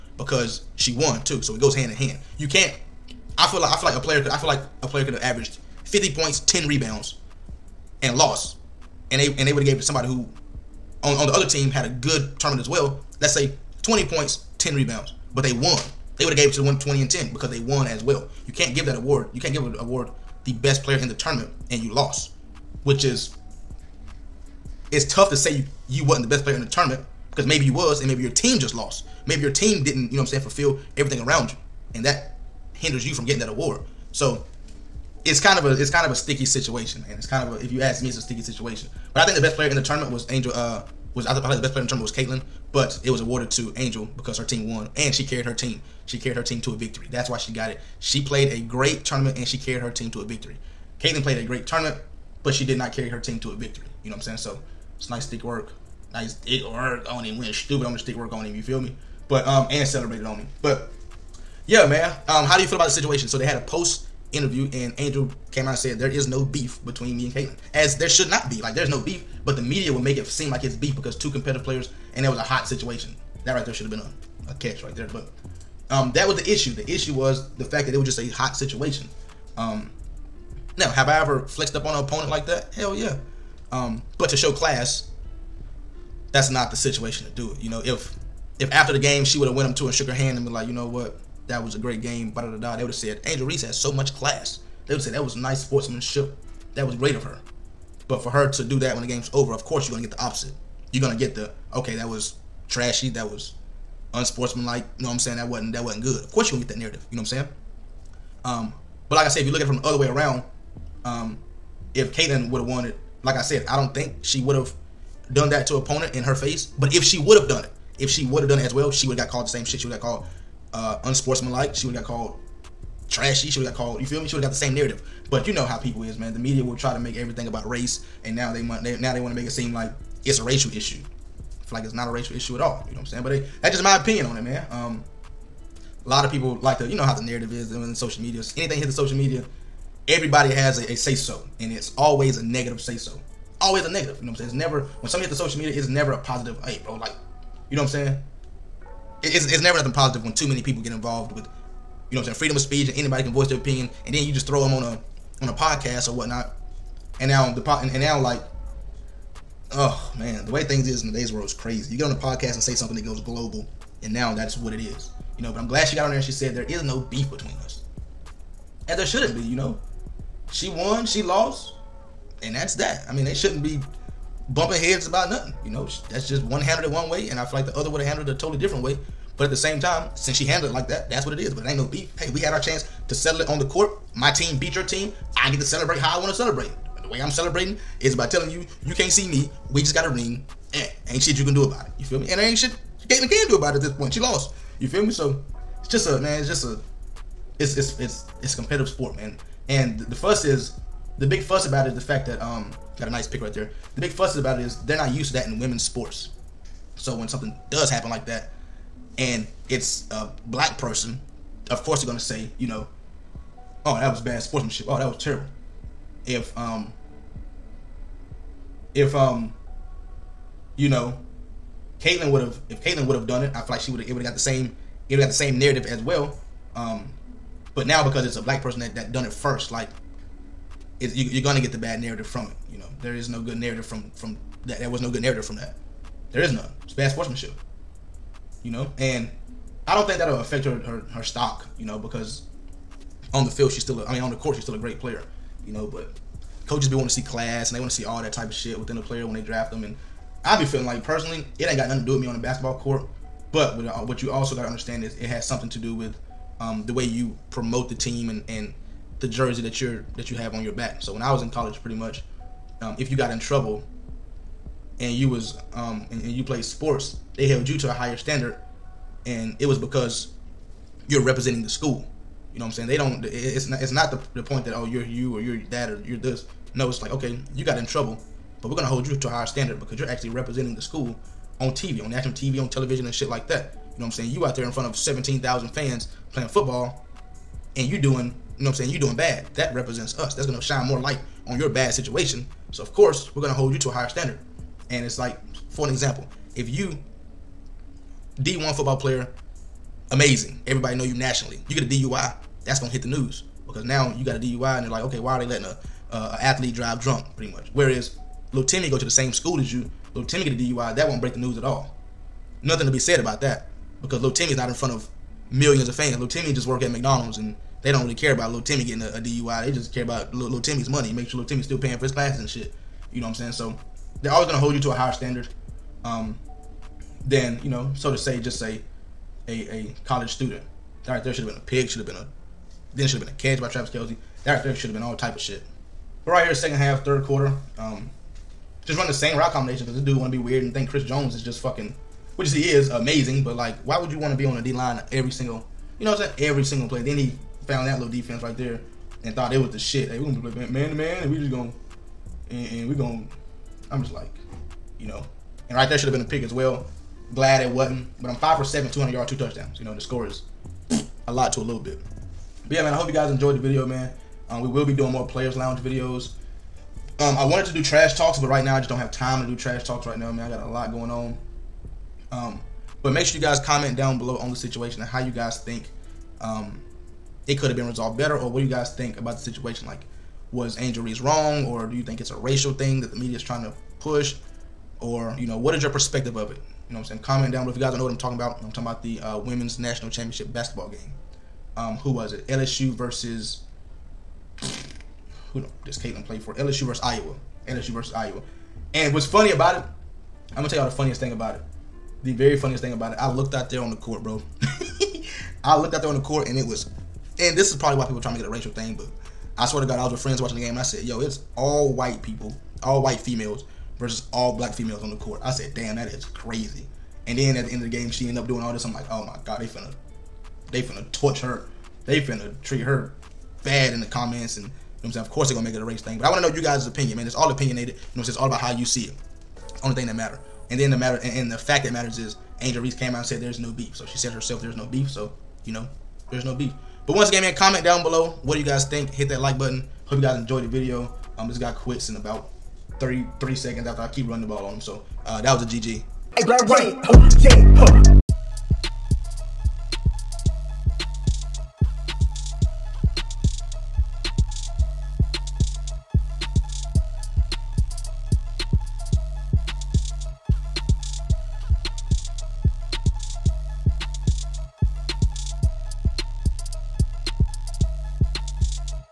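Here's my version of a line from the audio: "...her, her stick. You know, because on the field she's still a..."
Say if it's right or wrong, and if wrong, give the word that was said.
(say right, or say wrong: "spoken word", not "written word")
wrong: "stock", not "stick".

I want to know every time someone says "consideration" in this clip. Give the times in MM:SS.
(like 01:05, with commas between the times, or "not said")
not said.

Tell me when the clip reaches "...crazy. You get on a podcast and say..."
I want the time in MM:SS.
02:41.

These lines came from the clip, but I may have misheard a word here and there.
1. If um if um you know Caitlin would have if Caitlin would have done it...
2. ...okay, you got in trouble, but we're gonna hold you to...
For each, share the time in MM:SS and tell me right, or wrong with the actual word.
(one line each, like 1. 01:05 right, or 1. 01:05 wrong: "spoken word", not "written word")
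1. 03:36 right
2. 04:37 right.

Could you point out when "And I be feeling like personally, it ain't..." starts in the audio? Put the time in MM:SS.
04:09.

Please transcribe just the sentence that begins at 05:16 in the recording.
Little Timmy just work at McDonald's and they don't really care about little Timmy getting a, a DUI.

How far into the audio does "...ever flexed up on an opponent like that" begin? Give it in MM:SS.
01:21.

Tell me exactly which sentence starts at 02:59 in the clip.
But at the same time, since she handled it like that, that's what it is.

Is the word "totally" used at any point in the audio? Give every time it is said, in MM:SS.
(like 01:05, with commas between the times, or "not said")
02:58.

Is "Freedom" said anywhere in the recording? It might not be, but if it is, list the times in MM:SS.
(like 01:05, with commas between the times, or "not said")
02:32.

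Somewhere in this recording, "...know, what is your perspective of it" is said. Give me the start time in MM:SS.
06:25.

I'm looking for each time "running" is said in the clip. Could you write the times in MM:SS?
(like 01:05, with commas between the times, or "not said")
07:24.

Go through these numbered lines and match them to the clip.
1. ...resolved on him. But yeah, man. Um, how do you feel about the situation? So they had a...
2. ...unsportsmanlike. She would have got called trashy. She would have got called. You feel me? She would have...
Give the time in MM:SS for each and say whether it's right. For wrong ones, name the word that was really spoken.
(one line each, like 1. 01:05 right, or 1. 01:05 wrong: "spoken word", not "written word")
1. 00:59 wrong: "celebrated", not "resolved"
2. 02:01 right.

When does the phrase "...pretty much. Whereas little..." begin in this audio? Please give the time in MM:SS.
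05:07.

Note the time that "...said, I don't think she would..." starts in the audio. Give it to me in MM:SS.
01:53.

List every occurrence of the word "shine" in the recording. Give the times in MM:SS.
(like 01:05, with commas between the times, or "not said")
04:50.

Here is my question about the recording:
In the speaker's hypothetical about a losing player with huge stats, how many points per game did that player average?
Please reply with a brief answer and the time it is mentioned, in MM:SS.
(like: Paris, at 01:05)
50, at 00:05.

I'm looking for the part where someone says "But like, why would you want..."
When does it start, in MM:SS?
05:43.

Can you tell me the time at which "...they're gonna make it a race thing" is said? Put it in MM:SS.
07:05.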